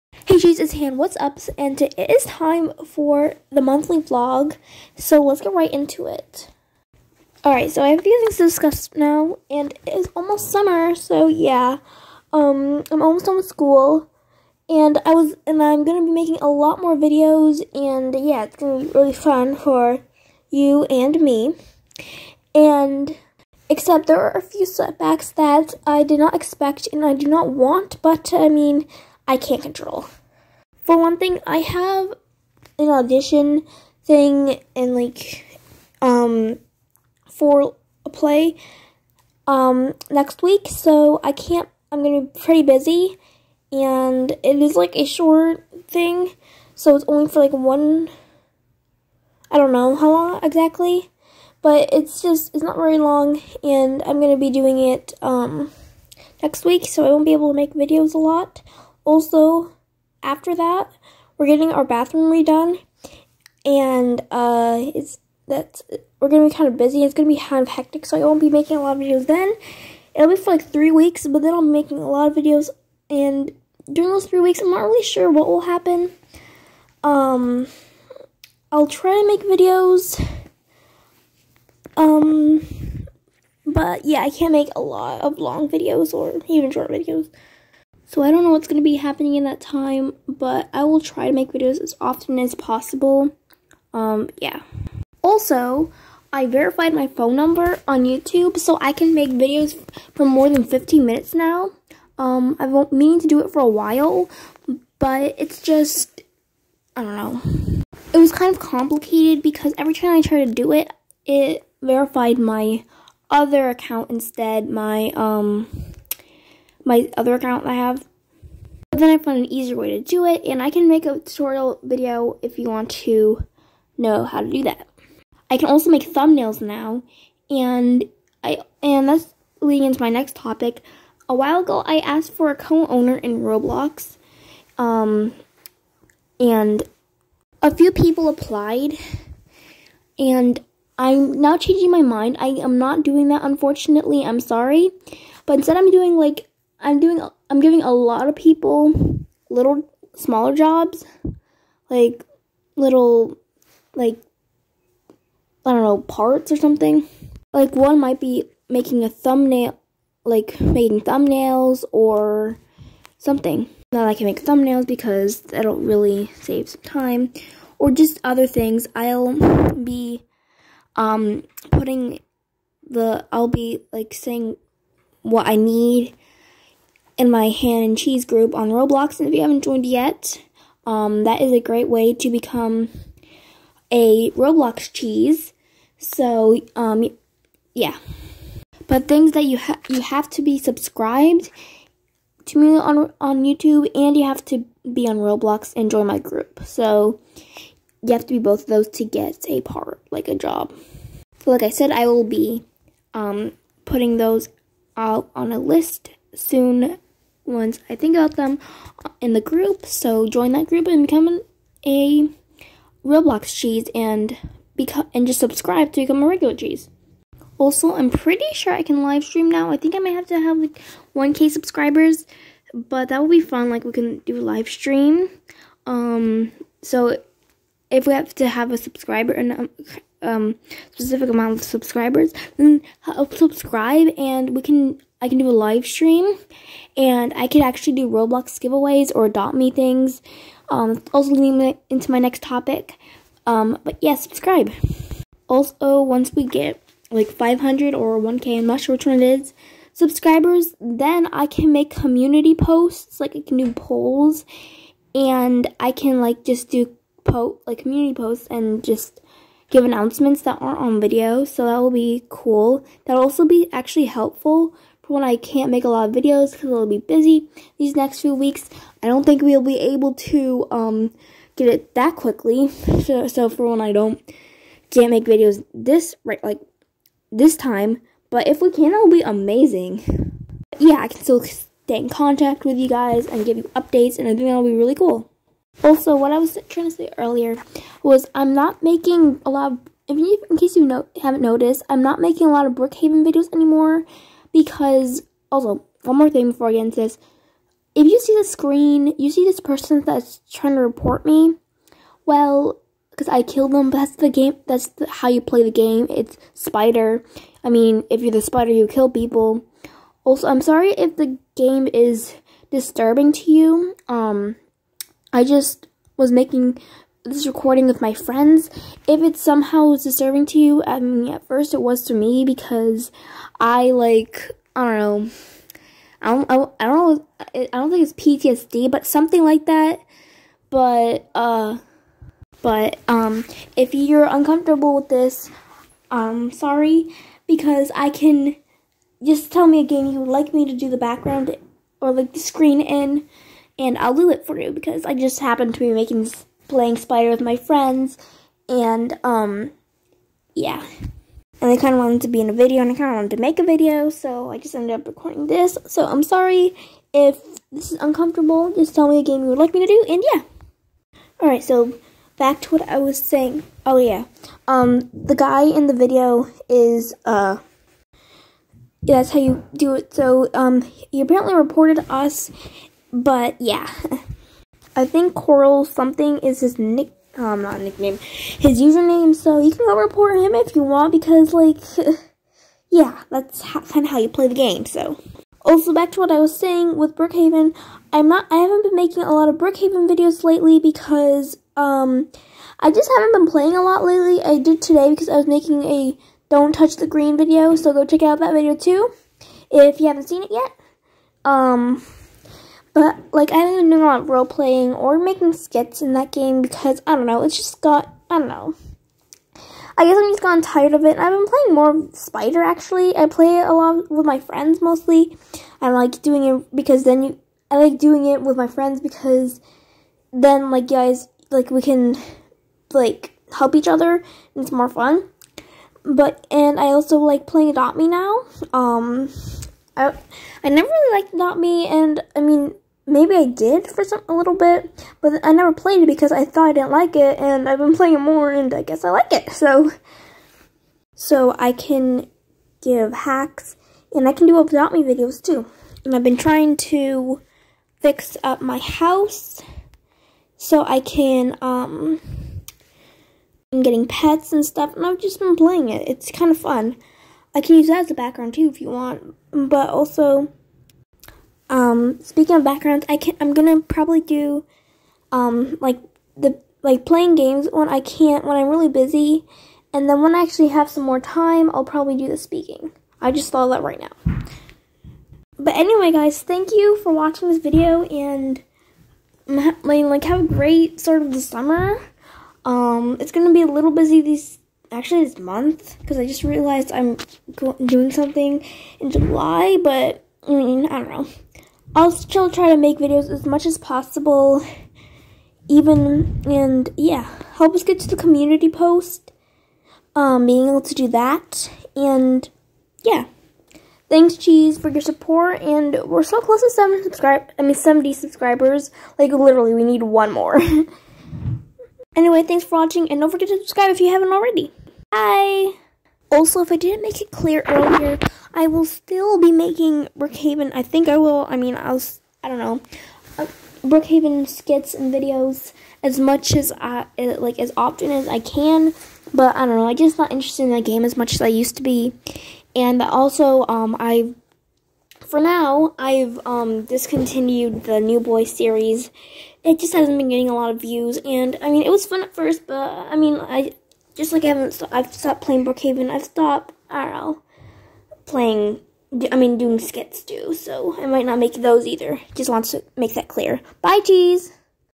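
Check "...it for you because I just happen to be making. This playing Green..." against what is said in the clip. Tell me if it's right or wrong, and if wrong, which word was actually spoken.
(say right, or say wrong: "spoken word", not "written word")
wrong: "Spider", not "Green".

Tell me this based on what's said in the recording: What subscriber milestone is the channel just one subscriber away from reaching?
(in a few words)
70.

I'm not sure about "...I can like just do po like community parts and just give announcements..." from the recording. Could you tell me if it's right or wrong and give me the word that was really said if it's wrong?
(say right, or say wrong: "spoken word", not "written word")
wrong: "posts", not "parts".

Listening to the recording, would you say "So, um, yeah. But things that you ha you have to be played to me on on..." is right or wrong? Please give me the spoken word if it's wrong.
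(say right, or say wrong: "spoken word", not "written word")
wrong: "subscribed", not "played".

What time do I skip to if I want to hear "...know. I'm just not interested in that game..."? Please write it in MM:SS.
08:49.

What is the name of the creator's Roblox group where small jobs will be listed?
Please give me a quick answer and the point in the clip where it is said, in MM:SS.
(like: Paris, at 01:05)
Han N Cheese, at 02:57.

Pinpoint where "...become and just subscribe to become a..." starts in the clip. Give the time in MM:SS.
03:34.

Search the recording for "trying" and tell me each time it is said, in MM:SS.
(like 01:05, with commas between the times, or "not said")
04:46, 05:00, 07:26.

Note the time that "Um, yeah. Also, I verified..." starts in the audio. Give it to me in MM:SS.
01:33.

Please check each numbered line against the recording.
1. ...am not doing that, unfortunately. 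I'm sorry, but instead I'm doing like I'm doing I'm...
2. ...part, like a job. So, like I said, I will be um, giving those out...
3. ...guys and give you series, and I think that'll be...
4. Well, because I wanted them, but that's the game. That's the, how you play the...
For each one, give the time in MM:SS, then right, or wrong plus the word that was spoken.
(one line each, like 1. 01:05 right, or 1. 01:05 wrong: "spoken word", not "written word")
1. 02:22 right
2. 03:19 wrong: "putting", not "giving"
3. 04:42 wrong: "updates", not "series"
4. 05:02 wrong: "killed", not "wanted".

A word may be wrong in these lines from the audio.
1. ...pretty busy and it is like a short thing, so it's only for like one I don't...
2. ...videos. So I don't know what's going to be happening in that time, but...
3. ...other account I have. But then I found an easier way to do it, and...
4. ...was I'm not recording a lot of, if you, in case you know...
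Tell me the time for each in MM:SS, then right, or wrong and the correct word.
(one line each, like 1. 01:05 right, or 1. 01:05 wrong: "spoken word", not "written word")
1. 00:42 right
2. 01:26 right
3. 01:57 right
4. 04:48 wrong: "making", not "recording".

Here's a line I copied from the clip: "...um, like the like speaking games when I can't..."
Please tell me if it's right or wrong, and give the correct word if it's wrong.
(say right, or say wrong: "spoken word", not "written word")
wrong: "playing", not "speaking".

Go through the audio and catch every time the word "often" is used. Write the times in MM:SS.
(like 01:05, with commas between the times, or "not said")
01:32, 08:47.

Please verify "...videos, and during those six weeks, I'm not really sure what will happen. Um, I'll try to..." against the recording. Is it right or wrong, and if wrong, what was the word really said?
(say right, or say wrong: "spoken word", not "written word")
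wrong: "three", not "six".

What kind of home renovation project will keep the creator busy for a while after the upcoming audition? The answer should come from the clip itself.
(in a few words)
bathroom redone.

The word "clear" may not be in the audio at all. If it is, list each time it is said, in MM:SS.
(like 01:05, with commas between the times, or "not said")
08:37, 09:13.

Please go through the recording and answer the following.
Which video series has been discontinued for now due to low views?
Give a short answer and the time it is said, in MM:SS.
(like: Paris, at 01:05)
New Boy, at 08:57.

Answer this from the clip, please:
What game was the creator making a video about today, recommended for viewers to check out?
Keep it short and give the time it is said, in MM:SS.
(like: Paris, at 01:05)
Don't Touch the Green, at 06:36.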